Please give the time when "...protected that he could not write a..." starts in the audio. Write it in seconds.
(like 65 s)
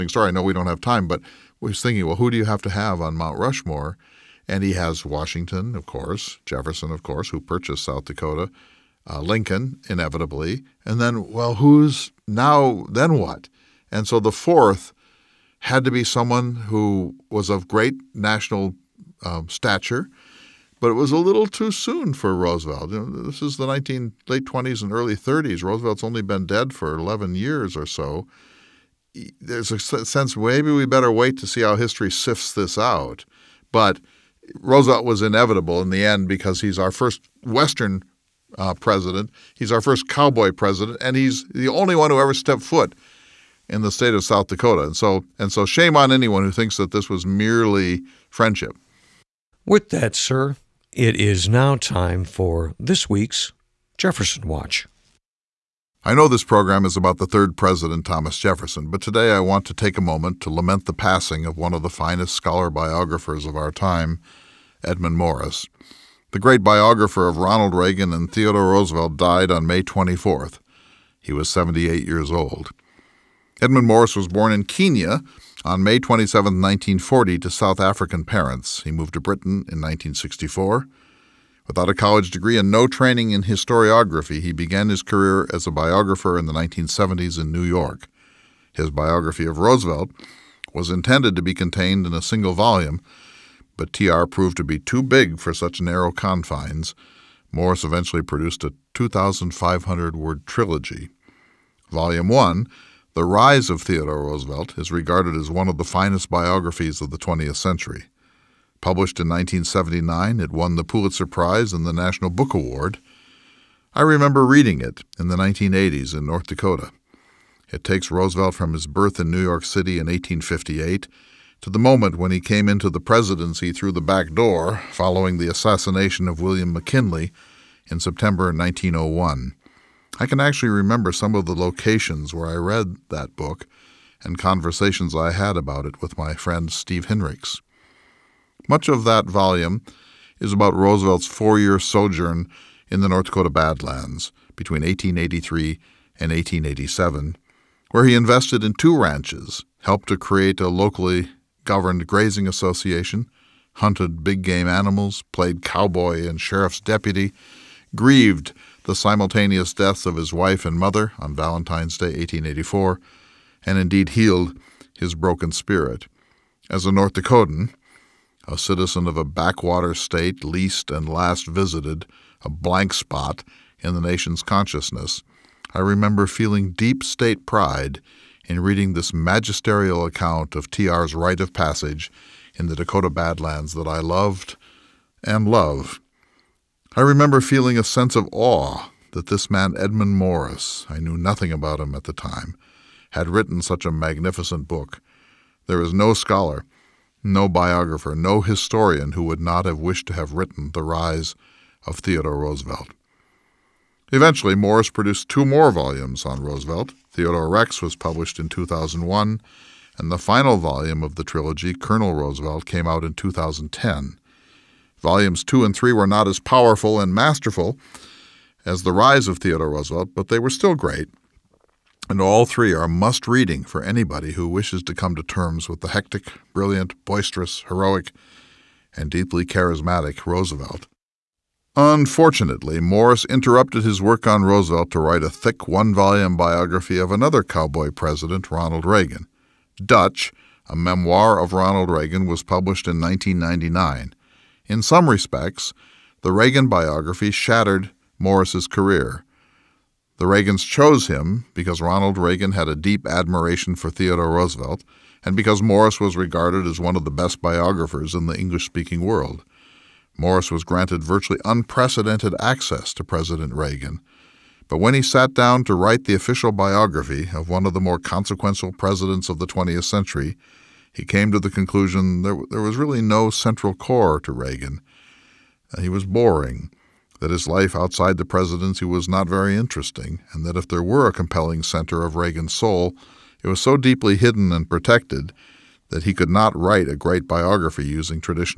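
284 s.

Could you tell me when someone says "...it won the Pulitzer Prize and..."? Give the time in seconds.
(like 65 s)
110 s.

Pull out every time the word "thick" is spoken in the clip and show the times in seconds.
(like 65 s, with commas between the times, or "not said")
235 s.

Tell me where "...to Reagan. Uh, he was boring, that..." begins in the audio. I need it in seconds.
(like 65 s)
274 s.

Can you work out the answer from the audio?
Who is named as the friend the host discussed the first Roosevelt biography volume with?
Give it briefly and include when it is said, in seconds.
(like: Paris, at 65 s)
Steve Hinrichs, at 136 s.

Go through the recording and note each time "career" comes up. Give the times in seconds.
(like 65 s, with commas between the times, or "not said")
85 s, 248 s.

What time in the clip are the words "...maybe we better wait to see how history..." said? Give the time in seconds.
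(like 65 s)
30 s.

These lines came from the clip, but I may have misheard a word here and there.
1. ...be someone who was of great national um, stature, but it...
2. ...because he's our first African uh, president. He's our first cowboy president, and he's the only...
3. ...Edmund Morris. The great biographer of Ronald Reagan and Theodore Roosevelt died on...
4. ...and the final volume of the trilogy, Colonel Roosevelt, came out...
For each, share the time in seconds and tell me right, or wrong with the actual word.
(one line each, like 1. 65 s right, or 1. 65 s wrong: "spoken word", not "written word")
1. 15 s right
2. 36 s wrong: "Western", not "African"
3. 64 s right
4. 209 s right.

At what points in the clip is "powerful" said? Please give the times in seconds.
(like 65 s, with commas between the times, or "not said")
216 s.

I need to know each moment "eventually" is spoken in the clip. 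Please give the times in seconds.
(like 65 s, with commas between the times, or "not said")
97 s, 204 s.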